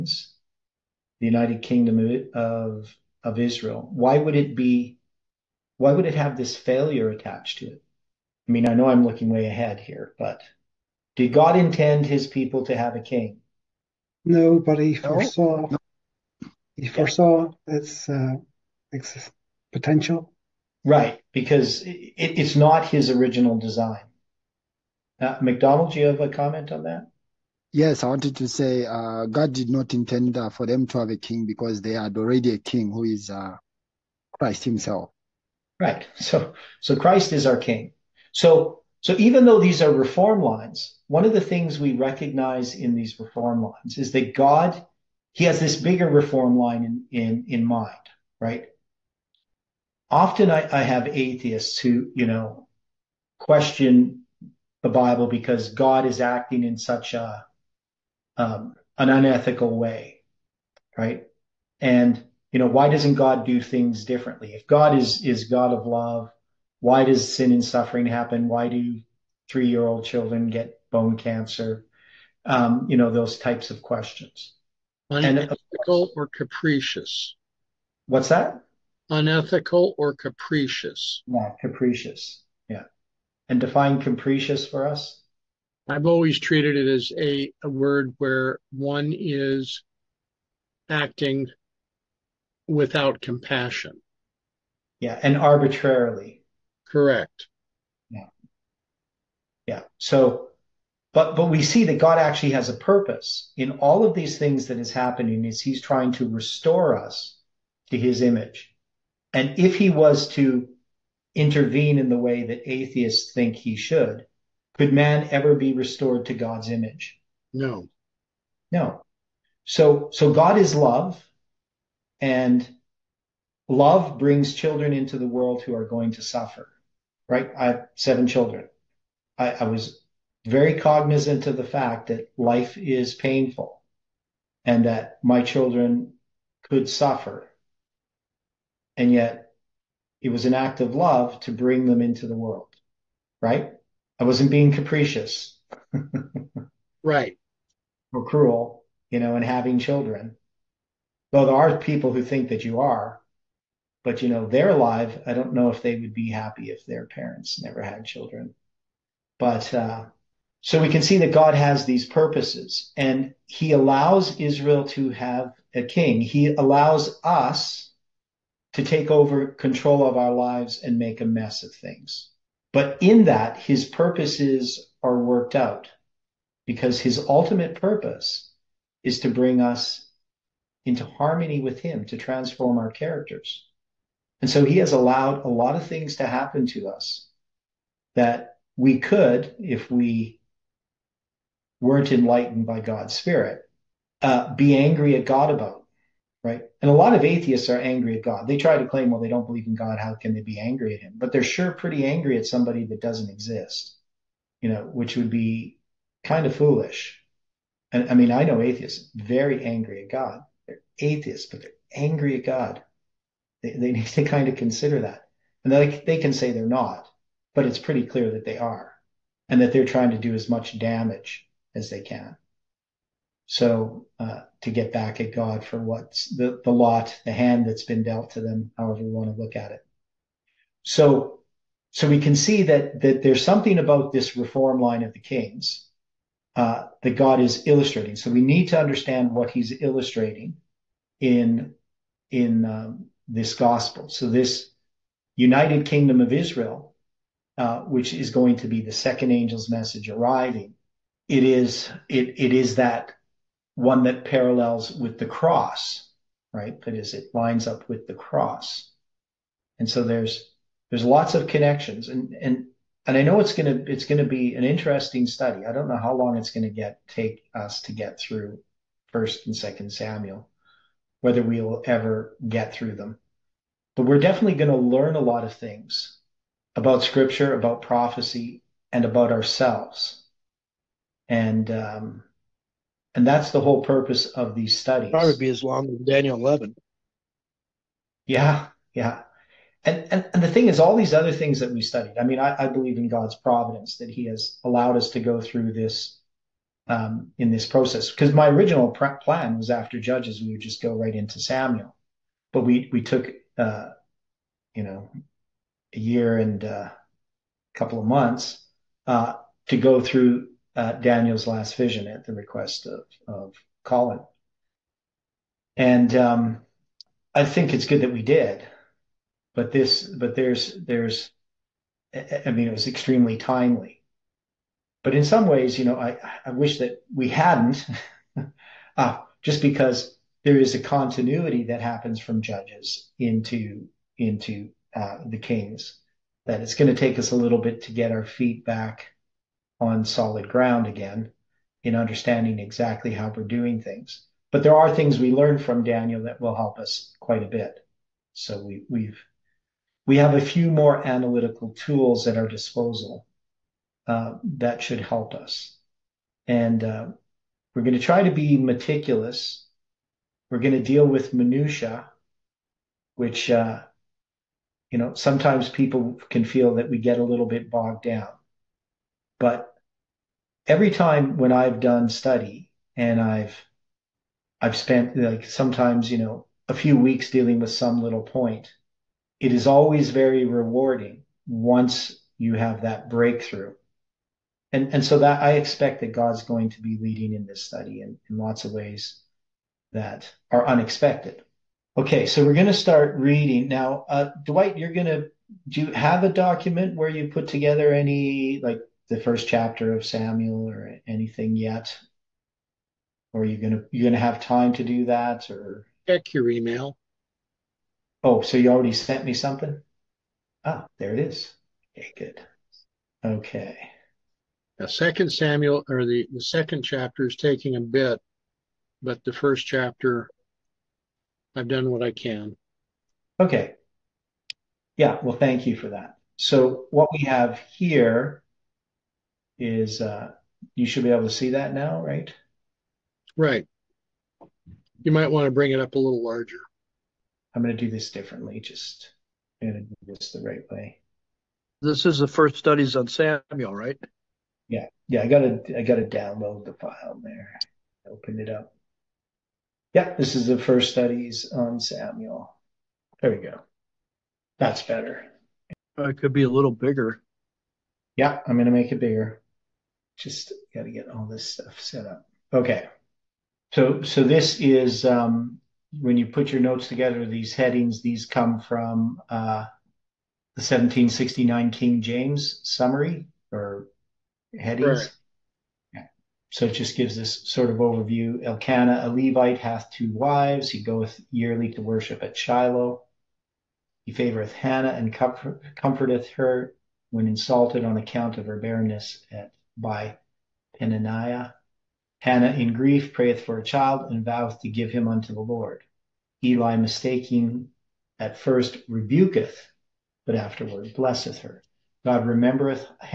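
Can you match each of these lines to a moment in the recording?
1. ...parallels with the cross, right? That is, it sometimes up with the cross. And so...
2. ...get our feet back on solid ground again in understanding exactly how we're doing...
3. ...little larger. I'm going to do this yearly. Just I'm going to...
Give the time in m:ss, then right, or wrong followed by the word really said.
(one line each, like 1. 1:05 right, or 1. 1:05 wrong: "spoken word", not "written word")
1. 4:14 wrong: "lines", not "sometimes"
2. 5:37 right
3. 7:15 wrong: "differently", not "yearly".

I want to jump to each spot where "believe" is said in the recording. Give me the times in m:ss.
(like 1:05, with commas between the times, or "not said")
3:19, 4:52.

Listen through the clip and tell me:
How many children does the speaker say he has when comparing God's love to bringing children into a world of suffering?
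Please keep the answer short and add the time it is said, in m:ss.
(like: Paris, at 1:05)
7, at 2:07.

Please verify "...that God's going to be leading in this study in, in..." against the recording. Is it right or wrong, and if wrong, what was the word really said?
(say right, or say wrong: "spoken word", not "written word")
right.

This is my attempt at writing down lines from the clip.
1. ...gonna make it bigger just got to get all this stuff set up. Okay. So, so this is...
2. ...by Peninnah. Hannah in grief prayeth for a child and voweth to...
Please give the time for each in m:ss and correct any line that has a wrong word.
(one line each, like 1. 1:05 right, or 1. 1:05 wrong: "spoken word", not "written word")
1. 7:38 right
2. 8:09 right.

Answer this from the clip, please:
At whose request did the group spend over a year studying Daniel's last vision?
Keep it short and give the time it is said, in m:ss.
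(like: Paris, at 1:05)
Colin, at 5:13.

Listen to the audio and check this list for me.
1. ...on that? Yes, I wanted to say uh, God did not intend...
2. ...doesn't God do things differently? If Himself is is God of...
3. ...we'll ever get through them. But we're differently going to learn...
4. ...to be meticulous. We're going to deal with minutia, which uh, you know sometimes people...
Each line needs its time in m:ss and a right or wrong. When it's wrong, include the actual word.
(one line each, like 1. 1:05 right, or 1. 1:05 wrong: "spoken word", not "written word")
1. 0:26 right
2. 1:02 wrong: "God", not "Himself"
3. 4:31 wrong: "definitely", not "differently"
4. 5:58 right.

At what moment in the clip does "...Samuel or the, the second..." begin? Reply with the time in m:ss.
6:55.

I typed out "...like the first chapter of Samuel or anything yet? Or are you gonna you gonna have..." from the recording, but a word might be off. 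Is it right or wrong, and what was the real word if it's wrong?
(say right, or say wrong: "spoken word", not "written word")
right.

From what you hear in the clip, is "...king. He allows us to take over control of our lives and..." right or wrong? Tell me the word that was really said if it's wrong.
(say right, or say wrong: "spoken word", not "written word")
right.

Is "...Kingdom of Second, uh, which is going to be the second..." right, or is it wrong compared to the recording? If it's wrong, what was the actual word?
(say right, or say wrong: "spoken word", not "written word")
wrong: "Israel", not "Second".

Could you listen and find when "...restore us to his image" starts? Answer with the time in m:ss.
1:46.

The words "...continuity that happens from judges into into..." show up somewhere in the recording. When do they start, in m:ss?
5:30.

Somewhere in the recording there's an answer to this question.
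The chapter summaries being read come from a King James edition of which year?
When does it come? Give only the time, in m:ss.
7:50.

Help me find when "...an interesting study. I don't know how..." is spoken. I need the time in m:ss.
4:24.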